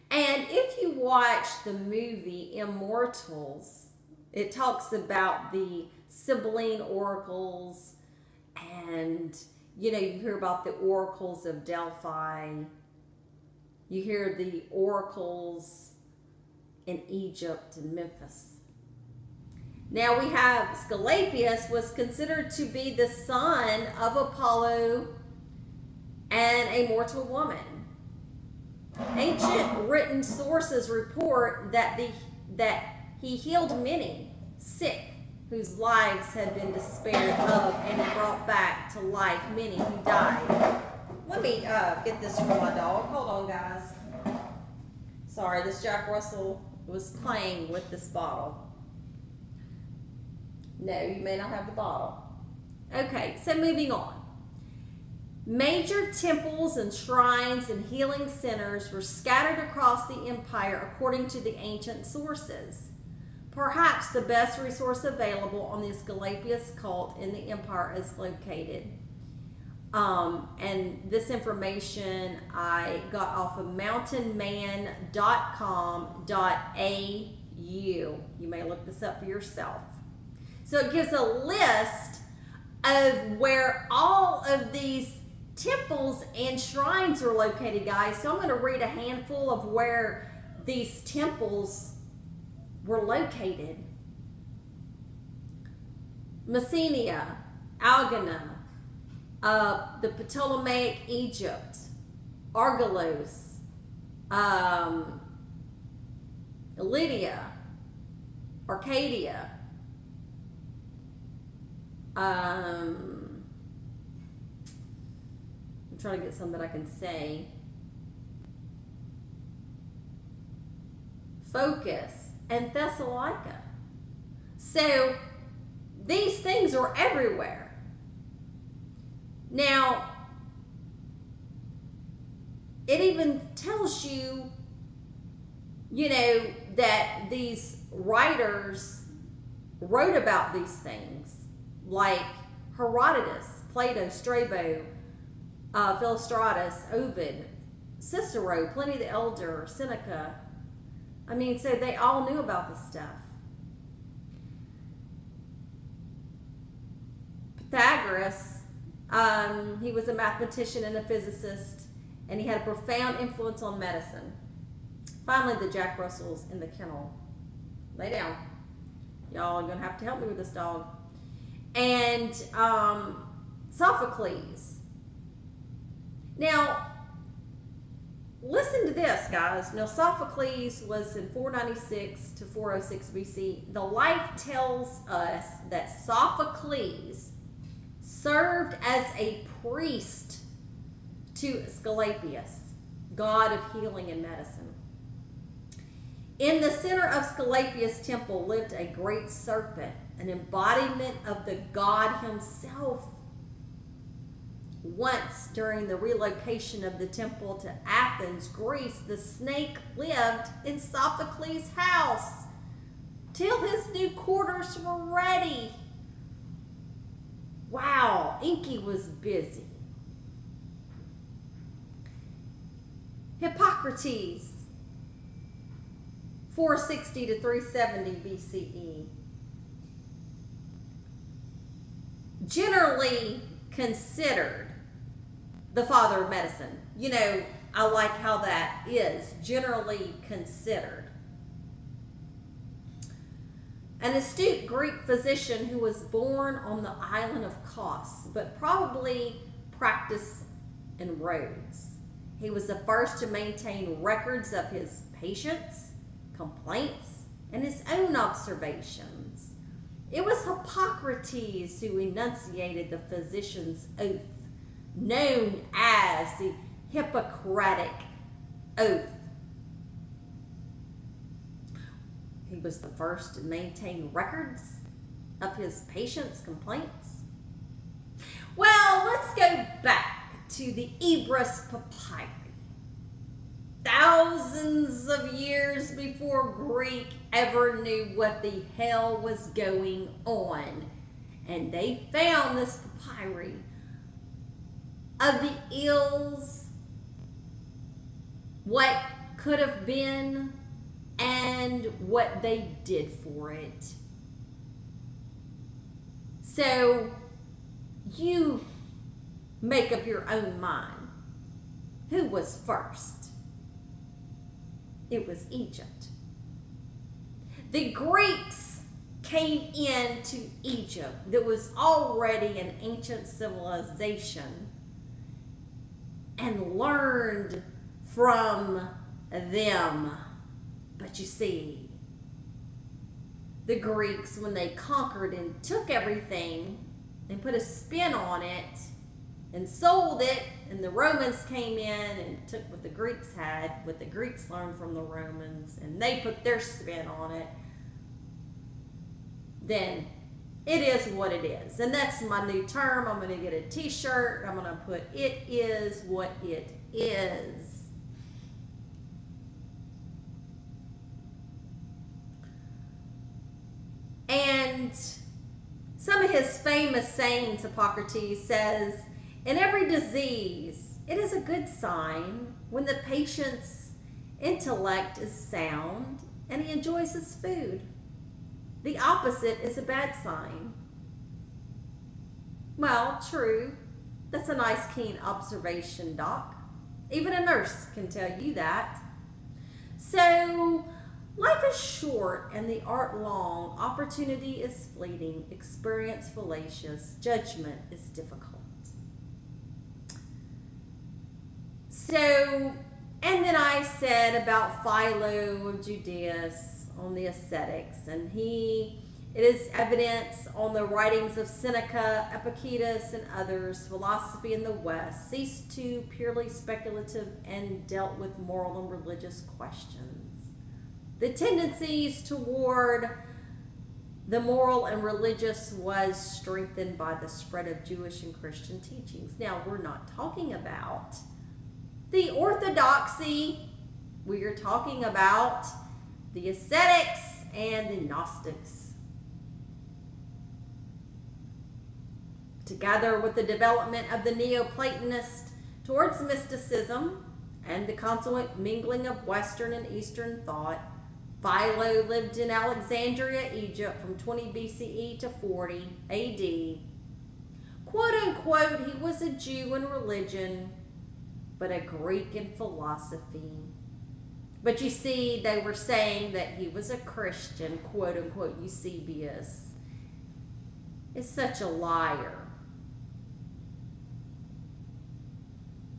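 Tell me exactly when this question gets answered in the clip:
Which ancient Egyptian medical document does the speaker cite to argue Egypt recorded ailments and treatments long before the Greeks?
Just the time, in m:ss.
4:41.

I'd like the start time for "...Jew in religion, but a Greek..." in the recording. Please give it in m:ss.
7:39.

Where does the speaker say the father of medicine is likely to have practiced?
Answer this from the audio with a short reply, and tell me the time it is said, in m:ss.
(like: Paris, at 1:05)
Rhodes, at 4:11.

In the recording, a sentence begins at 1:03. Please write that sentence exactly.
Perhaps the best resource available on the Esculapius cult in the empire is located.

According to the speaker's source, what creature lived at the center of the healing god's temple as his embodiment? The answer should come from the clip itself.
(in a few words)
serpent.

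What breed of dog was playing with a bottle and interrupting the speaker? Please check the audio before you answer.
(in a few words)
Jack Russell.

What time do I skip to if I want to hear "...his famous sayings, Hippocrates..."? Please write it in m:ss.
6:06.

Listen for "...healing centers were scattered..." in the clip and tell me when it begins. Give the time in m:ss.
0:57.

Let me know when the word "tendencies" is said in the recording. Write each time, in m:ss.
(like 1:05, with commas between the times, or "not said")
7:01.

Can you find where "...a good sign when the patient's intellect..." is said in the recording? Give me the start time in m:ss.
6:11.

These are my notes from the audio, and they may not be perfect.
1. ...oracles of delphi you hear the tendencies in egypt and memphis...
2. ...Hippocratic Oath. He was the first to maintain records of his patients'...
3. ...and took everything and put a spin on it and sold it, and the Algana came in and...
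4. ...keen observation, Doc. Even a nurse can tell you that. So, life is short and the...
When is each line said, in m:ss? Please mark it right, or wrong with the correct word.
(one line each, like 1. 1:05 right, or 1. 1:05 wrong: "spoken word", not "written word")
1. 0:10 wrong: "oracles", not "tendencies"
2. 4:26 right
3. 5:35 wrong: "Romans", not "Algana"
4. 6:24 right.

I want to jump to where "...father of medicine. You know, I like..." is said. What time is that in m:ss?
3:55.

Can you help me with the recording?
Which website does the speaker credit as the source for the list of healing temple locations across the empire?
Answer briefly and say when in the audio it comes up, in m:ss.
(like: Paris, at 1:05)
mountainman.com.au, at 1:13.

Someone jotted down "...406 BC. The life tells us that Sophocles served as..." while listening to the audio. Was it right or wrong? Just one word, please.
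right.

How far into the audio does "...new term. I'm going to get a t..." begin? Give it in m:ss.
5:52.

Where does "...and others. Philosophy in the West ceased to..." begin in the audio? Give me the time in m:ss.
6:53.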